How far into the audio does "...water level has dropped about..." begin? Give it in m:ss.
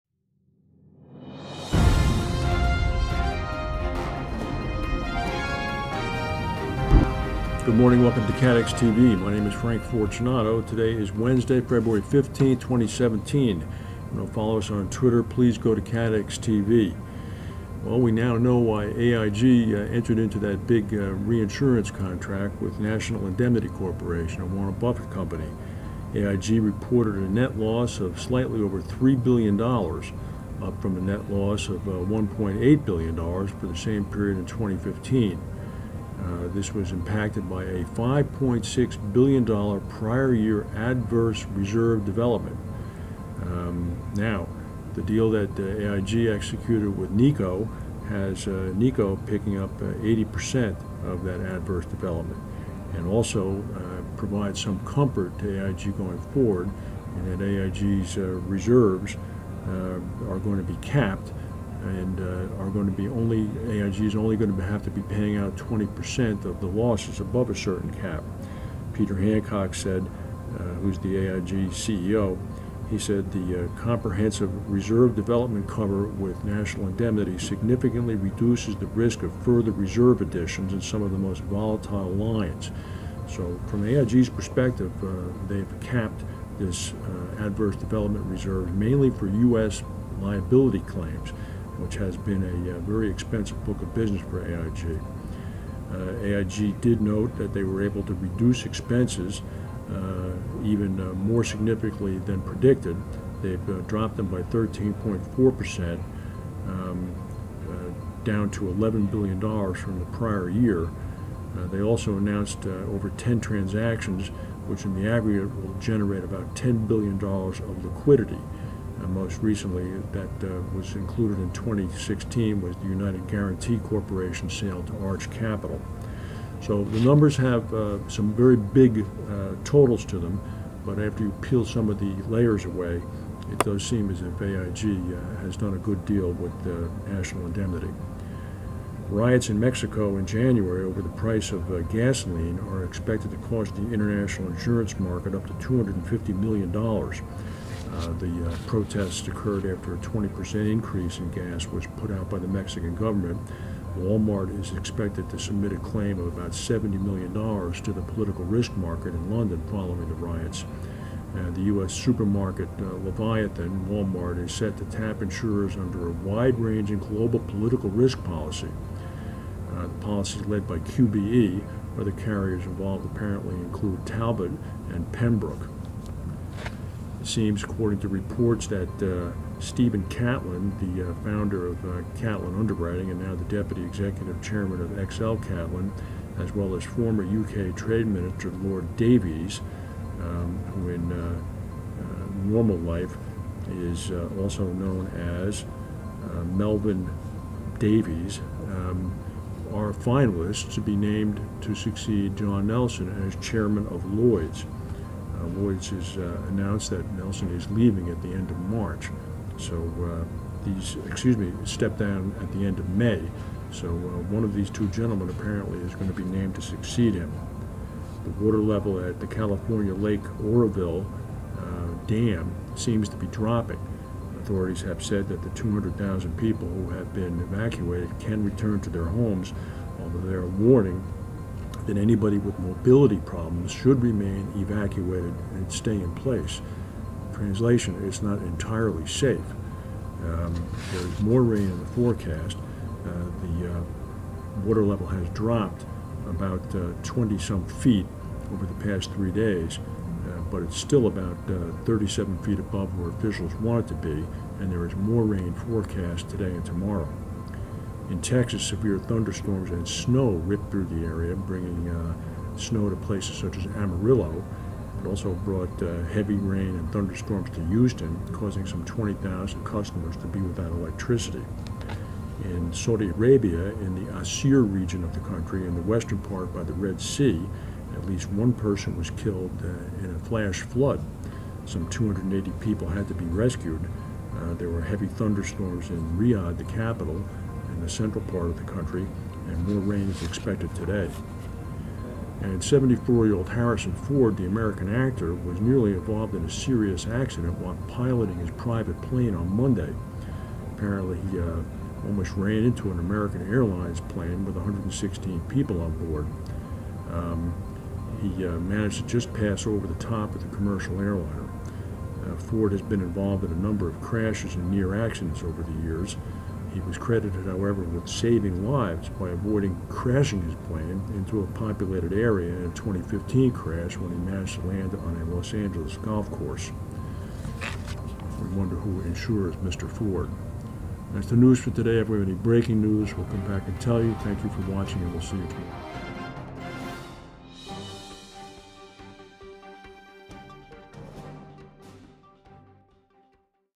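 4:04.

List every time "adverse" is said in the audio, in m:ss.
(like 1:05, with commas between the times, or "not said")
0:40, 0:51, 1:27.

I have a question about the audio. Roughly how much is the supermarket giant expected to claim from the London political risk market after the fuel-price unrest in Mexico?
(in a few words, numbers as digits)
$70 million.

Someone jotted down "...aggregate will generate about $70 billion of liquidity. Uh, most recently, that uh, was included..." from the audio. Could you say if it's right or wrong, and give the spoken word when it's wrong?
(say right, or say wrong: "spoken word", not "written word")
wrong: "10", not "70".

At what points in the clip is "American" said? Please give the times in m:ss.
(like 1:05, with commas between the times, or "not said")
4:54, 5:02.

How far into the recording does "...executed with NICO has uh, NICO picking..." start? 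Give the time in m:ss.
0:46.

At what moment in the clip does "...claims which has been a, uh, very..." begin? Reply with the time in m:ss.
1:30.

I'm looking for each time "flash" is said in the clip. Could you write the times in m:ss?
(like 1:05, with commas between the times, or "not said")
4:40.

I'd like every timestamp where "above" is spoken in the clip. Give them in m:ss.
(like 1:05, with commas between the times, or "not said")
1:07, 4:12.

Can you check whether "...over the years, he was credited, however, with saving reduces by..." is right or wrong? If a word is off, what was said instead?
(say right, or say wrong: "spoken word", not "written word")
wrong: "lives", not "reduces".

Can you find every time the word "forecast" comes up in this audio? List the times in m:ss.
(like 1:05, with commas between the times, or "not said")
4:01, 4:15.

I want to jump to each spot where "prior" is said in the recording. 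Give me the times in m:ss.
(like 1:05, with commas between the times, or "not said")
0:39, 1:50.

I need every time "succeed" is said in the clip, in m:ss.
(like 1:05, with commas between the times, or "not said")
3:21, 3:36.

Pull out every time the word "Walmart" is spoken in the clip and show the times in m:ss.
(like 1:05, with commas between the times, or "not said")
2:33, 2:43.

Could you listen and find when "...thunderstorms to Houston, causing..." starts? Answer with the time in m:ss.
4:26.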